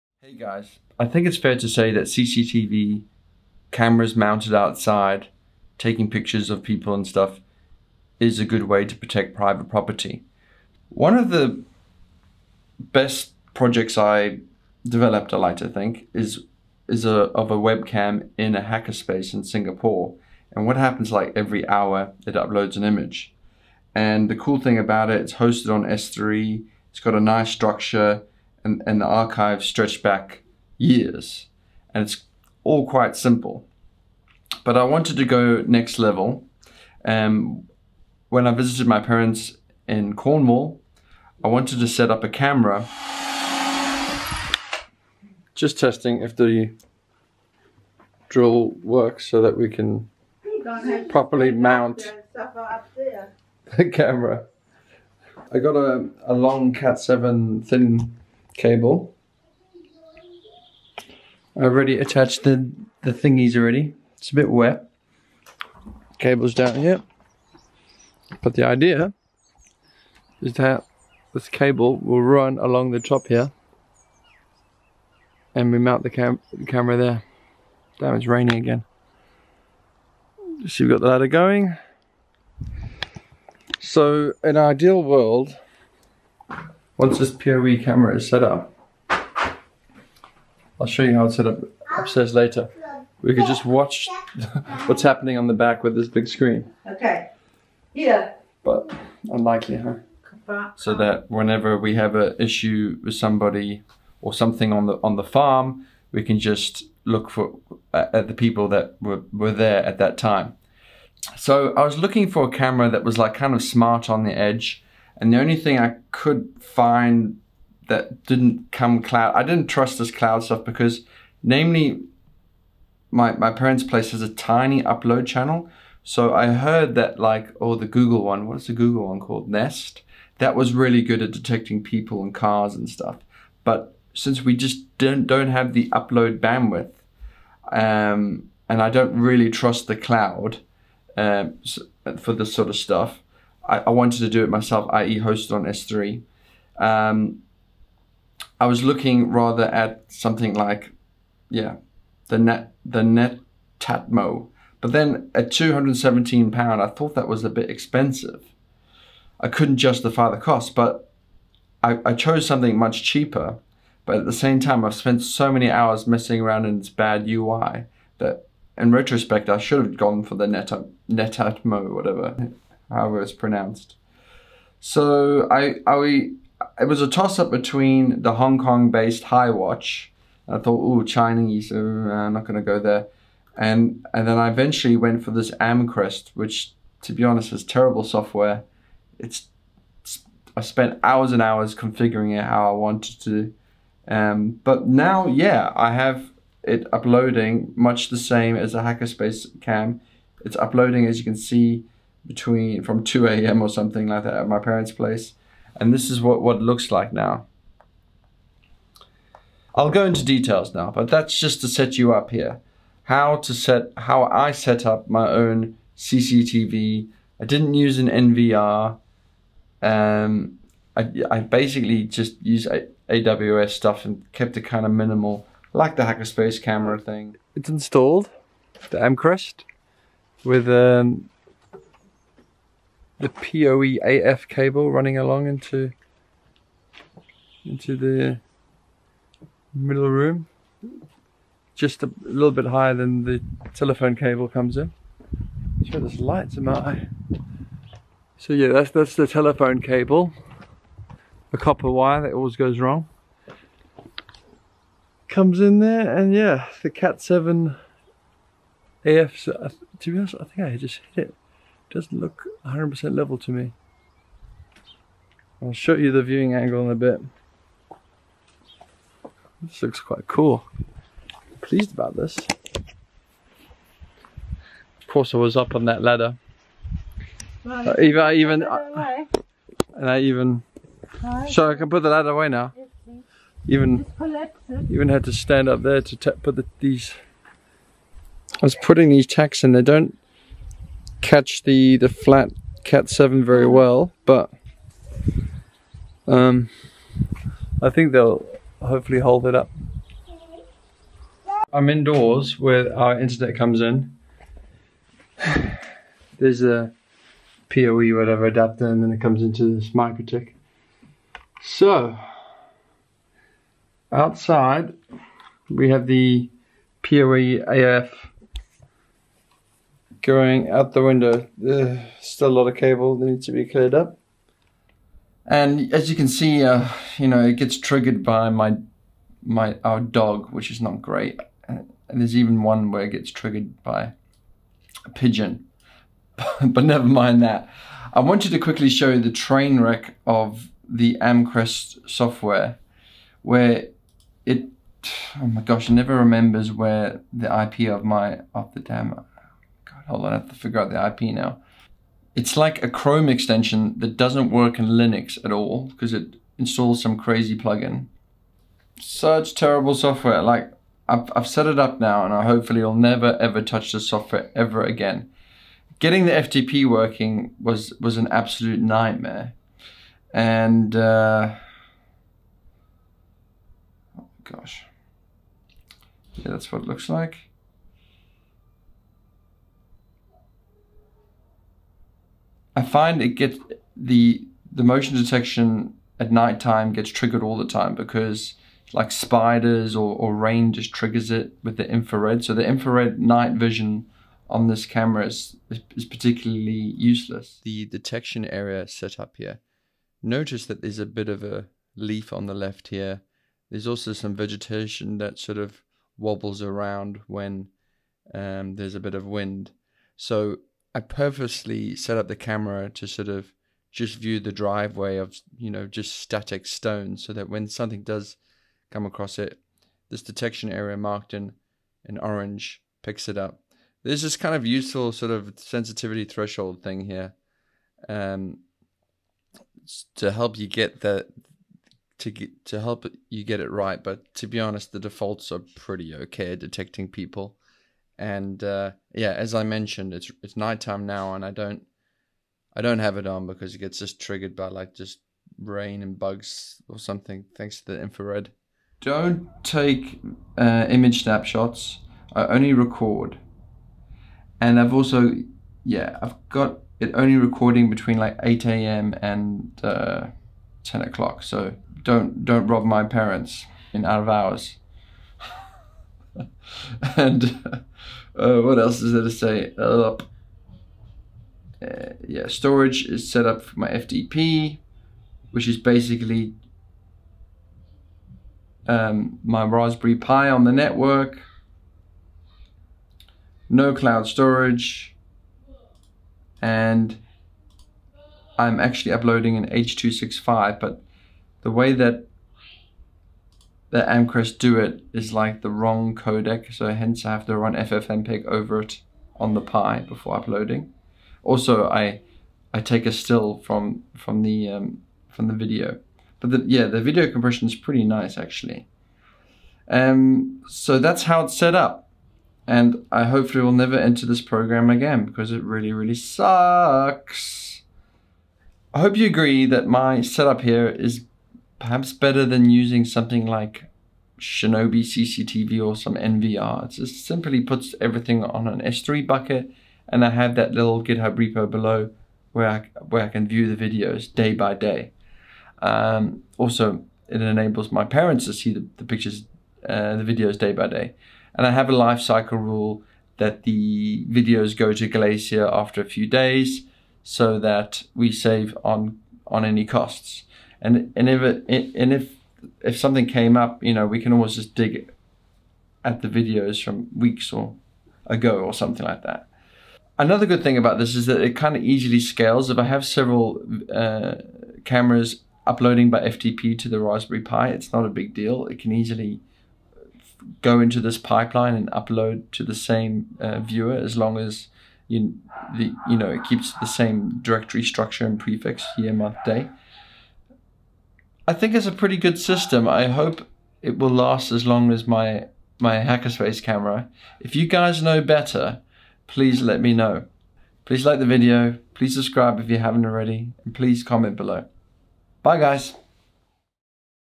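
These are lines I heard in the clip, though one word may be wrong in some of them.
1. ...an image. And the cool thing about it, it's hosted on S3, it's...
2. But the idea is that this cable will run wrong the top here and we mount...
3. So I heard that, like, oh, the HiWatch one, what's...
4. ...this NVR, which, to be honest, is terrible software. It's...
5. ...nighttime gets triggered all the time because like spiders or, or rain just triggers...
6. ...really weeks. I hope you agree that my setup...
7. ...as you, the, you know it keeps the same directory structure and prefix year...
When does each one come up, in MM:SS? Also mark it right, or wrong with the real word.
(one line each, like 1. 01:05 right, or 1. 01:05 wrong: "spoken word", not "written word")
1. 00:22 right
2. 01:08 wrong: "along", not "wrong"
3. 02:06 wrong: "Google", not "HiWatch"
4. 03:05 wrong: "Amcrest", not "NVR"
5. 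06:26 right
6. 08:35 wrong: "sucks", not "weeks"
7. 09:34 right.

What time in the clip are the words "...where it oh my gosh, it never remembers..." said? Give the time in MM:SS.
05:43.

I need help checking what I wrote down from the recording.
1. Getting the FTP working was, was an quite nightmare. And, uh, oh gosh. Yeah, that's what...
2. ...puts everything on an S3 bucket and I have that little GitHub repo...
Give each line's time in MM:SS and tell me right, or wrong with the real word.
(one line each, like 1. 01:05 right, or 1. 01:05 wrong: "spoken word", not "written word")
1. 06:05 wrong: "absolute", not "quite"
2. 08:47 right.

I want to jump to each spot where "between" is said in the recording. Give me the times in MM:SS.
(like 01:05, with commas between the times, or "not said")
02:57, 03:22, 07:37.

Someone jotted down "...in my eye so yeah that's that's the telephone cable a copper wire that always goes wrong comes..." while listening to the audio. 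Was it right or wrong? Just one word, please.
right.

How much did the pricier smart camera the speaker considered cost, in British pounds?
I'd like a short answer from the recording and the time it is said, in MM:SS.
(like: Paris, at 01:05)
217 pounds, at 02:35.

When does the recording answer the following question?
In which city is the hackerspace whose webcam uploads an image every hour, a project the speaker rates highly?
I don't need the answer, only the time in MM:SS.
00:19.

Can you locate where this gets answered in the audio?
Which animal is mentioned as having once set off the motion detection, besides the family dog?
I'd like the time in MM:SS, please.
05:35.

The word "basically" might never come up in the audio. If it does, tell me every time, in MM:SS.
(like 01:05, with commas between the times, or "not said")
03:41, 07:55.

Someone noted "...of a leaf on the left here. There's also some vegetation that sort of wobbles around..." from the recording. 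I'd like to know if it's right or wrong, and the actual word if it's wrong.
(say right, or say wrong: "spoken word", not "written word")
right.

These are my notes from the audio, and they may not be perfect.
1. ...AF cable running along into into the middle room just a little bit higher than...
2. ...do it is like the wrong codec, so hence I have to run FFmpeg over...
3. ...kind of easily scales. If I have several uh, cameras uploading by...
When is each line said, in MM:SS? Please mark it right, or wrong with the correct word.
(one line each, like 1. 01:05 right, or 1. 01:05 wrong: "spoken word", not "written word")
1. 03:54 right
2. 08:14 right
3. 09:21 right.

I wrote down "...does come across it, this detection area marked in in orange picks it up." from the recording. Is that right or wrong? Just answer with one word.
right.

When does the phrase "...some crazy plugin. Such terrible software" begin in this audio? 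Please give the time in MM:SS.
05:57.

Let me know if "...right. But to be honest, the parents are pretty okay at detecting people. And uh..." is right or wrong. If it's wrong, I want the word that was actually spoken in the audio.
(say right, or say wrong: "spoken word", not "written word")
wrong: "defaults", not "parents".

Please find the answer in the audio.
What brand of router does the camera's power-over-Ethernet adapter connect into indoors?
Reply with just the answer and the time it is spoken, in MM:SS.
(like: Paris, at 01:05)
MikroTik, at 05:09.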